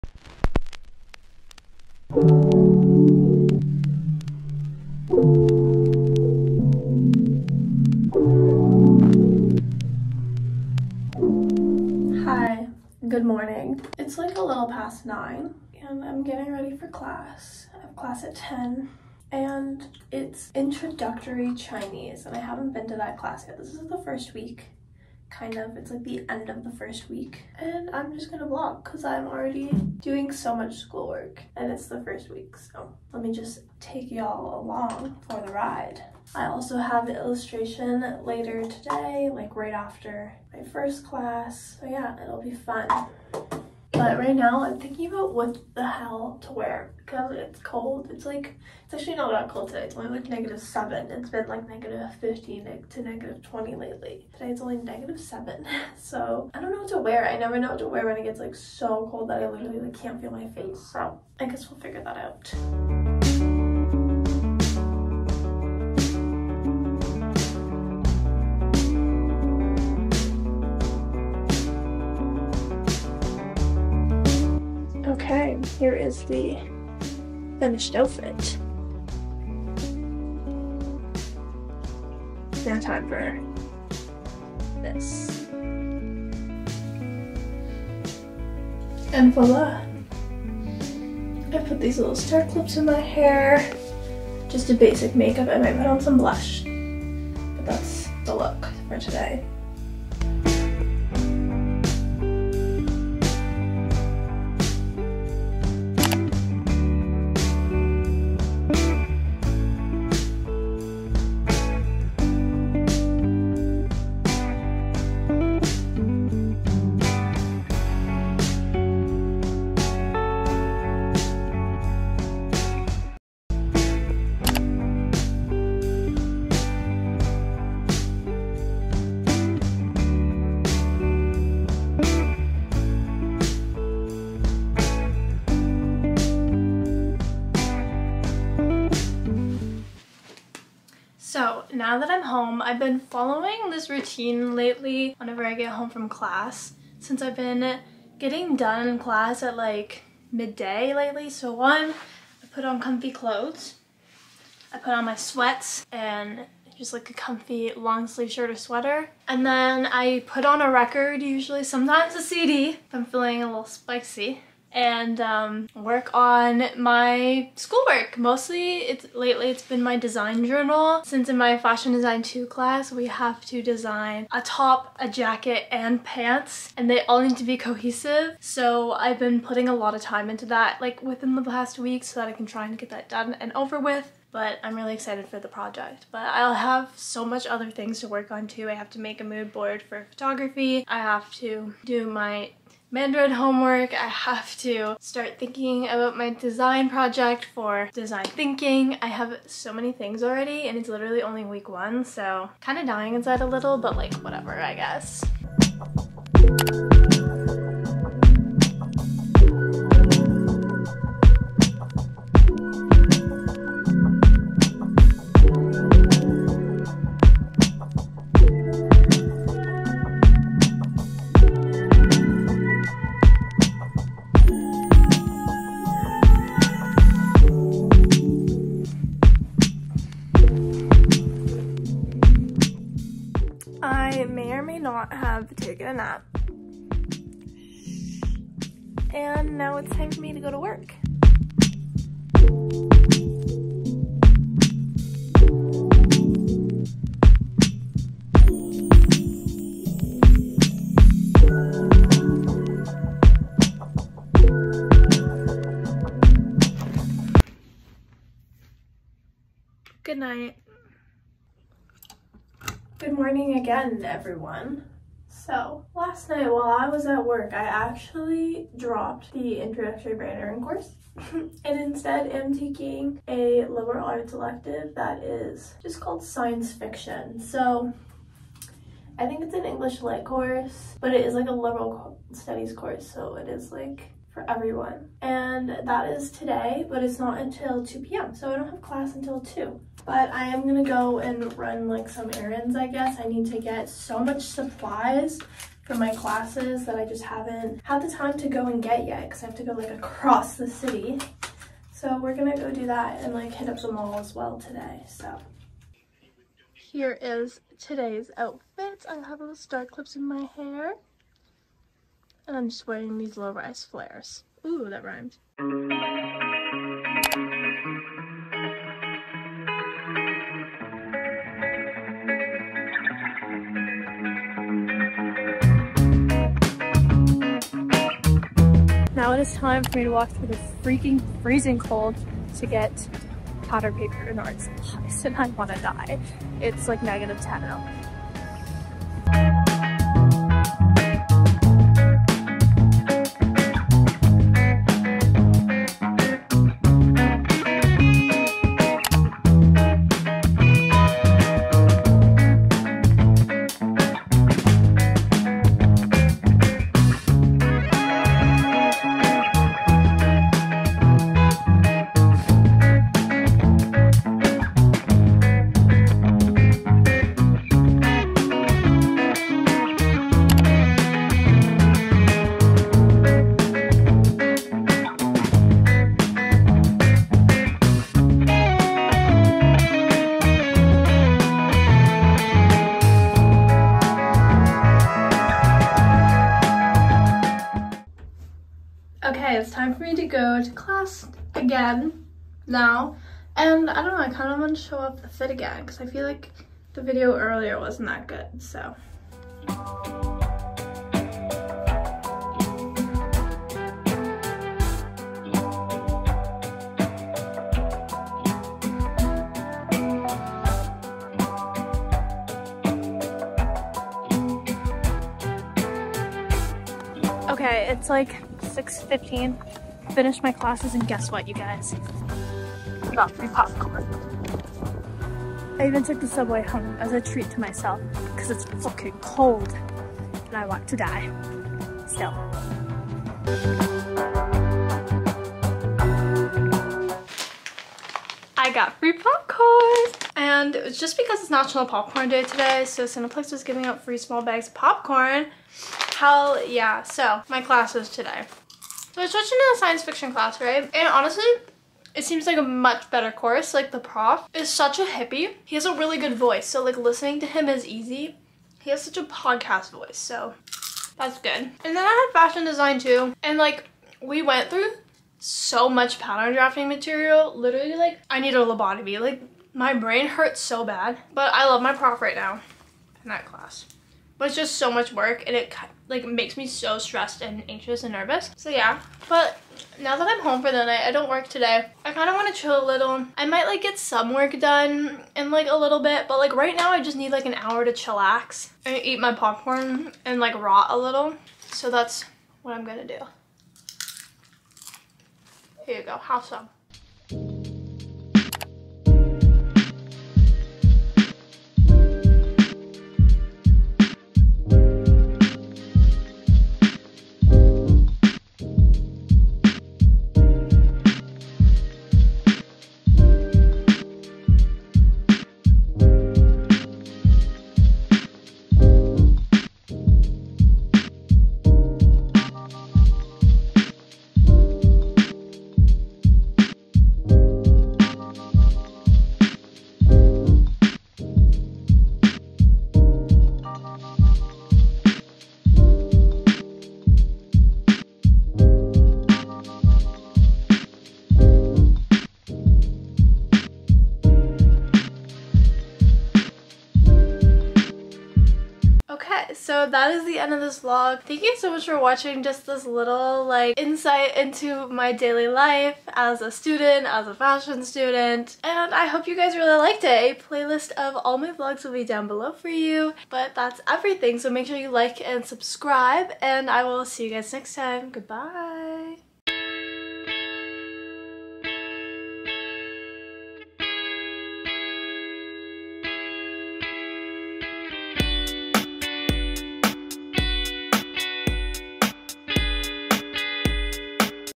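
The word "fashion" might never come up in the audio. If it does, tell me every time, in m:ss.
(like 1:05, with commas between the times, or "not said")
2:51, 7:42, 9:17.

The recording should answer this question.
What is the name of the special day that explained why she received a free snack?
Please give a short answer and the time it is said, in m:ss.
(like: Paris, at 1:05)
National Popcorn Day, at 7:21.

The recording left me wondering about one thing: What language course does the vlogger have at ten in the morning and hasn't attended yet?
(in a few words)
Introductory Chinese.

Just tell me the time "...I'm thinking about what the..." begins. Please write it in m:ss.
0:44.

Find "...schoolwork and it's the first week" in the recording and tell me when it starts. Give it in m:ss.
0:30.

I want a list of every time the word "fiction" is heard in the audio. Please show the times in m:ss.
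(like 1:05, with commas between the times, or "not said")
4:36, 7:30.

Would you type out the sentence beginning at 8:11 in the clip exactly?
So that's what I'm gonna do.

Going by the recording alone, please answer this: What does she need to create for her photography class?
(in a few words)
A mood board.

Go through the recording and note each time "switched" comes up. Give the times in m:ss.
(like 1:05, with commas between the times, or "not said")
7:29.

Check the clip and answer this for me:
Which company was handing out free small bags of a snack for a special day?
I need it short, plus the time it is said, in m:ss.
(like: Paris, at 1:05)
Cineplex, at 7:23.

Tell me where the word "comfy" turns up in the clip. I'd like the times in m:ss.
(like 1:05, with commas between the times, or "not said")
2:32, 2:37.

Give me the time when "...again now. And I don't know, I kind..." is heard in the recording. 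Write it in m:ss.
6:31.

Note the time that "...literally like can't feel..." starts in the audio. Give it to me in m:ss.
0:59.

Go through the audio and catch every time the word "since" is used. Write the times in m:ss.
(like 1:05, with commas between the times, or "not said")
2:27, 2:51.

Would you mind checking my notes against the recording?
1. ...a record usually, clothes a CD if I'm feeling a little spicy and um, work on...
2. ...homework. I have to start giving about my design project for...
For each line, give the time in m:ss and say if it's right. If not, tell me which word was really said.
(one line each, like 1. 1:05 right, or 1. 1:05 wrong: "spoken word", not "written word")
1. 2:40 wrong: "sometimes", not "clothes"
2. 3:13 wrong: "thinking", not "giving".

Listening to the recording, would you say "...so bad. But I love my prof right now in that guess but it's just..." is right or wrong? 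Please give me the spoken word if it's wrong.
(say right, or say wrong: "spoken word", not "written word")
wrong: "class", not "guess".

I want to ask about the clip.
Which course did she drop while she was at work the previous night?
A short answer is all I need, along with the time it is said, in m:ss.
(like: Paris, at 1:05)
Introductory branding, at 4:29.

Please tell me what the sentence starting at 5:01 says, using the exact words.
So we're gonna go do that and like hit up the mall as well today, so.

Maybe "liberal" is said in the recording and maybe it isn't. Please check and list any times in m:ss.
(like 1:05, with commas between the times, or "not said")
4:33, 4:41.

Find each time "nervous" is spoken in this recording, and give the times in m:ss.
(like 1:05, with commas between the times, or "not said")
7:58.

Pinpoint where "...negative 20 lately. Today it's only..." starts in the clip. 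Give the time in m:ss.
0:53.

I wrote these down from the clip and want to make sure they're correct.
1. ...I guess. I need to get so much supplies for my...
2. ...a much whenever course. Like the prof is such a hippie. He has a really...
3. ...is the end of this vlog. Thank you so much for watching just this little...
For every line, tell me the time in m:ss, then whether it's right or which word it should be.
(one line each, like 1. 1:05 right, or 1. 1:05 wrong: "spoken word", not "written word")
1. 4:52 right
2. 7:32 wrong: "better", not "whenever"
3. 9:10 right.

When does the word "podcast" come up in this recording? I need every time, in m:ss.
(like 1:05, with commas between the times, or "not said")
7:39.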